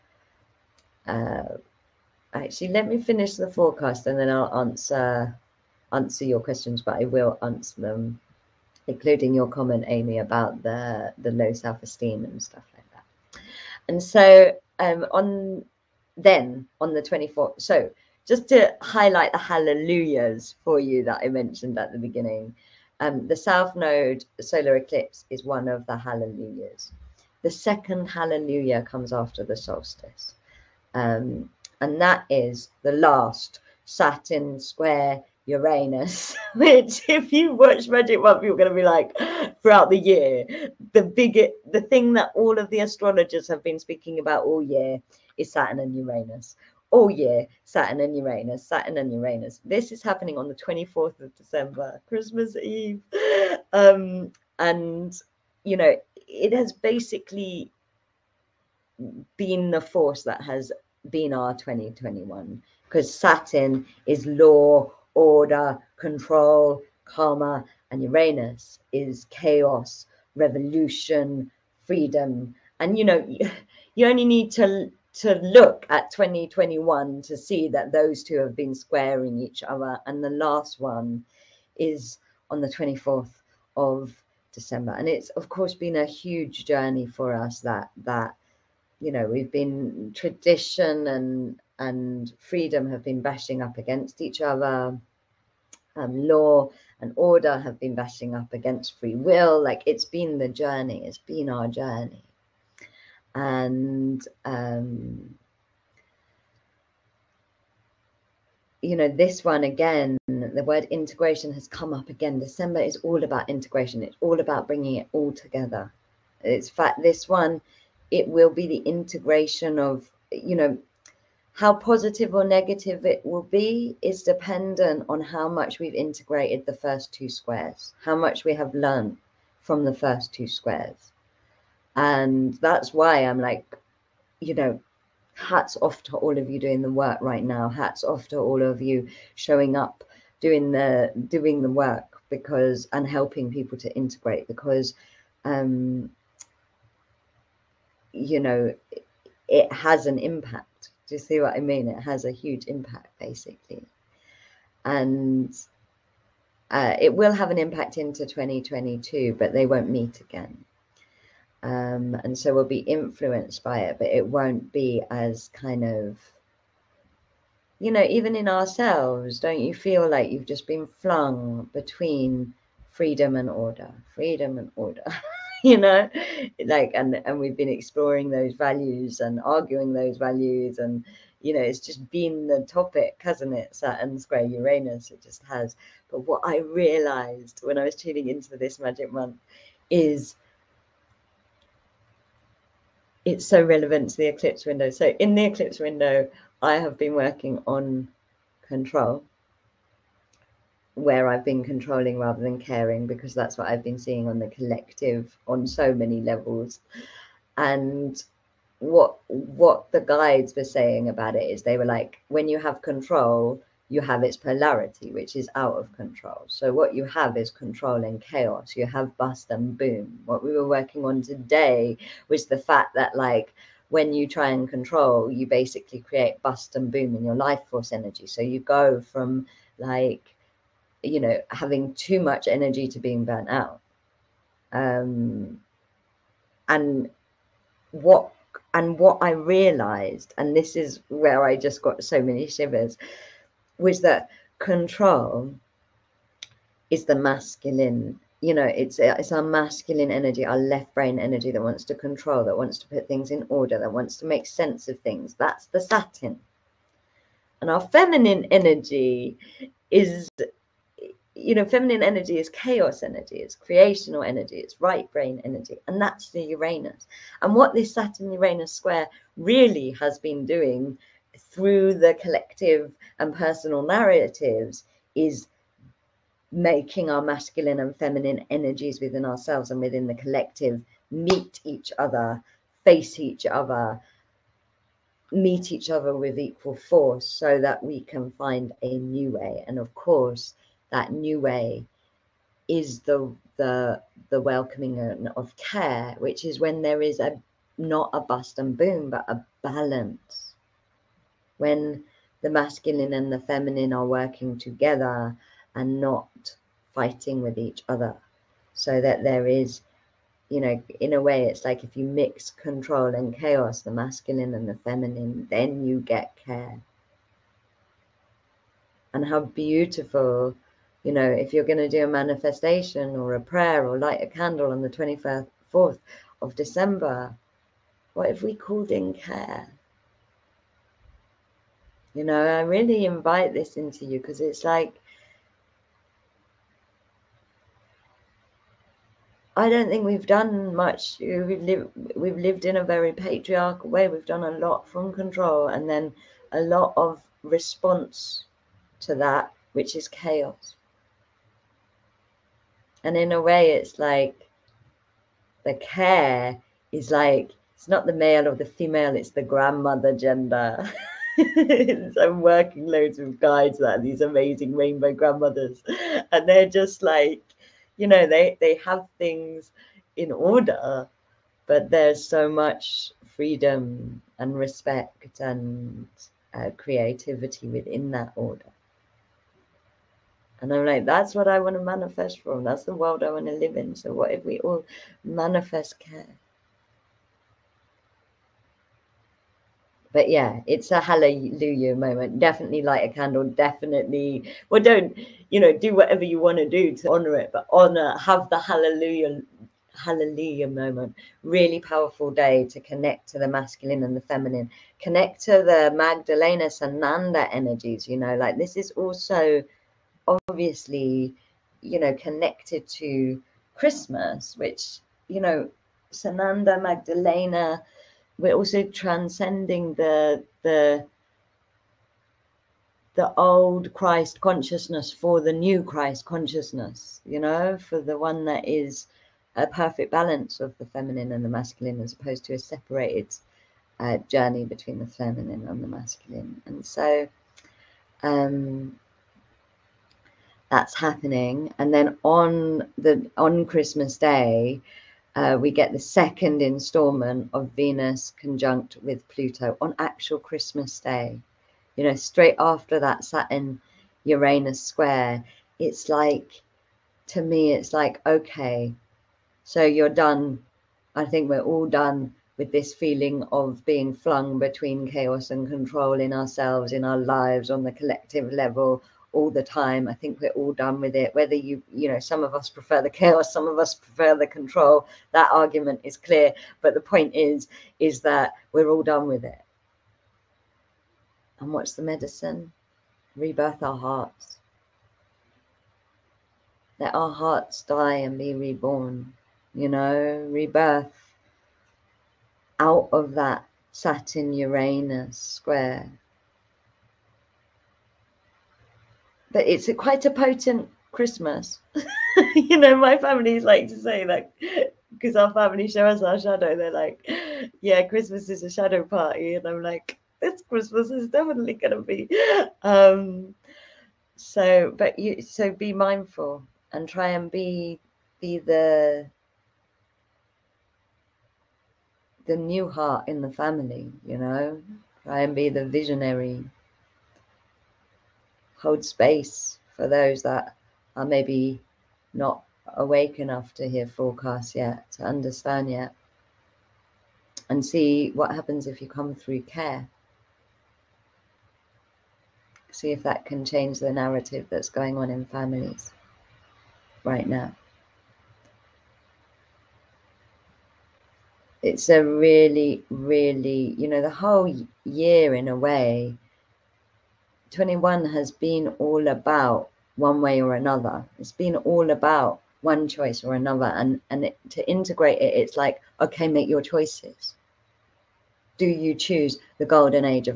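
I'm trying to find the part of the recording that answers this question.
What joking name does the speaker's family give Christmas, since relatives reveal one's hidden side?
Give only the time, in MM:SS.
08:28.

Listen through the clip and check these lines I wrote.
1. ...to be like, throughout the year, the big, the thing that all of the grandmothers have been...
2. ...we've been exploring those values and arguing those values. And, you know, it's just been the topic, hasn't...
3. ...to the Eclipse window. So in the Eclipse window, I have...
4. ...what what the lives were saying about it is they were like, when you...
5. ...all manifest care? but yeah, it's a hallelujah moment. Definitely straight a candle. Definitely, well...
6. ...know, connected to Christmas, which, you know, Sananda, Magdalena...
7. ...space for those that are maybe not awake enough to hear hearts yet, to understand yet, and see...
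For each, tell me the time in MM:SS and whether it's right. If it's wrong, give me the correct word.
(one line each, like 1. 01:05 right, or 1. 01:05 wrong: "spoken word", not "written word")
1. 00:38 wrong: "astrologers", not "grandmothers"
2. 02:57 right
3. 03:14 right
4. 03:28 wrong: "guides", not "lives"
5. 06:24 wrong: "light", not "straight"
6. 06:51 right
7. 08:49 wrong: "forecasts", not "hearts".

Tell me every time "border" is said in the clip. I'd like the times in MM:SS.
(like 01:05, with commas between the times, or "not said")
not said.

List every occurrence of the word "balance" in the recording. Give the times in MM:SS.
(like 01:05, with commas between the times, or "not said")
04:59, 07:10.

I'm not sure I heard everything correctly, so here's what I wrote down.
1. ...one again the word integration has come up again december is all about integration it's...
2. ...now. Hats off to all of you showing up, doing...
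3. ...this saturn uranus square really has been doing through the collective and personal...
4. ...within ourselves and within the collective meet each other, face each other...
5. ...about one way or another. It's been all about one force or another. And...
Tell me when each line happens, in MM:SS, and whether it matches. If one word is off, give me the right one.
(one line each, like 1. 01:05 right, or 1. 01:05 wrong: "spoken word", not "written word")
1. 01:49 right
2. 02:17 right
3. 04:27 right
4. 04:38 right
5. 09:19 wrong: "choice", not "force".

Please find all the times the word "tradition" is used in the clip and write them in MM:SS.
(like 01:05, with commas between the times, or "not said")
01:30.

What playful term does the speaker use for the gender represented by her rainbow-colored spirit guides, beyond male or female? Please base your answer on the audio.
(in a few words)
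grandmother gender.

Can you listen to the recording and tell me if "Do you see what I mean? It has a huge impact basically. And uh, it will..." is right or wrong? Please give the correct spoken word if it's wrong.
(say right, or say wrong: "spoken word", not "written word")
right.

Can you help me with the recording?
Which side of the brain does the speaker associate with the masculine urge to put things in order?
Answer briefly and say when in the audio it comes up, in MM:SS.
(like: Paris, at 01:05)
left brain, at 04:10.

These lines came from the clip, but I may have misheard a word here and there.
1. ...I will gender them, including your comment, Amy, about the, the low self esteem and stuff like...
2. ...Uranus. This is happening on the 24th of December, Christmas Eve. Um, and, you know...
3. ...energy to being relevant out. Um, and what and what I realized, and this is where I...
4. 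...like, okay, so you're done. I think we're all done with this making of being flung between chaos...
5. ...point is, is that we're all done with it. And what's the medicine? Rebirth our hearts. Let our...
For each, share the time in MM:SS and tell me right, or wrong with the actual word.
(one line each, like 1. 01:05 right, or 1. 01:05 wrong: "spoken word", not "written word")
1. 00:06 wrong: "answer", not "gender"
2. 00:49 right
3. 03:52 wrong: "burnt", not "relevant"
4. 07:37 wrong: "feeling", not "making"
5. 07:56 right.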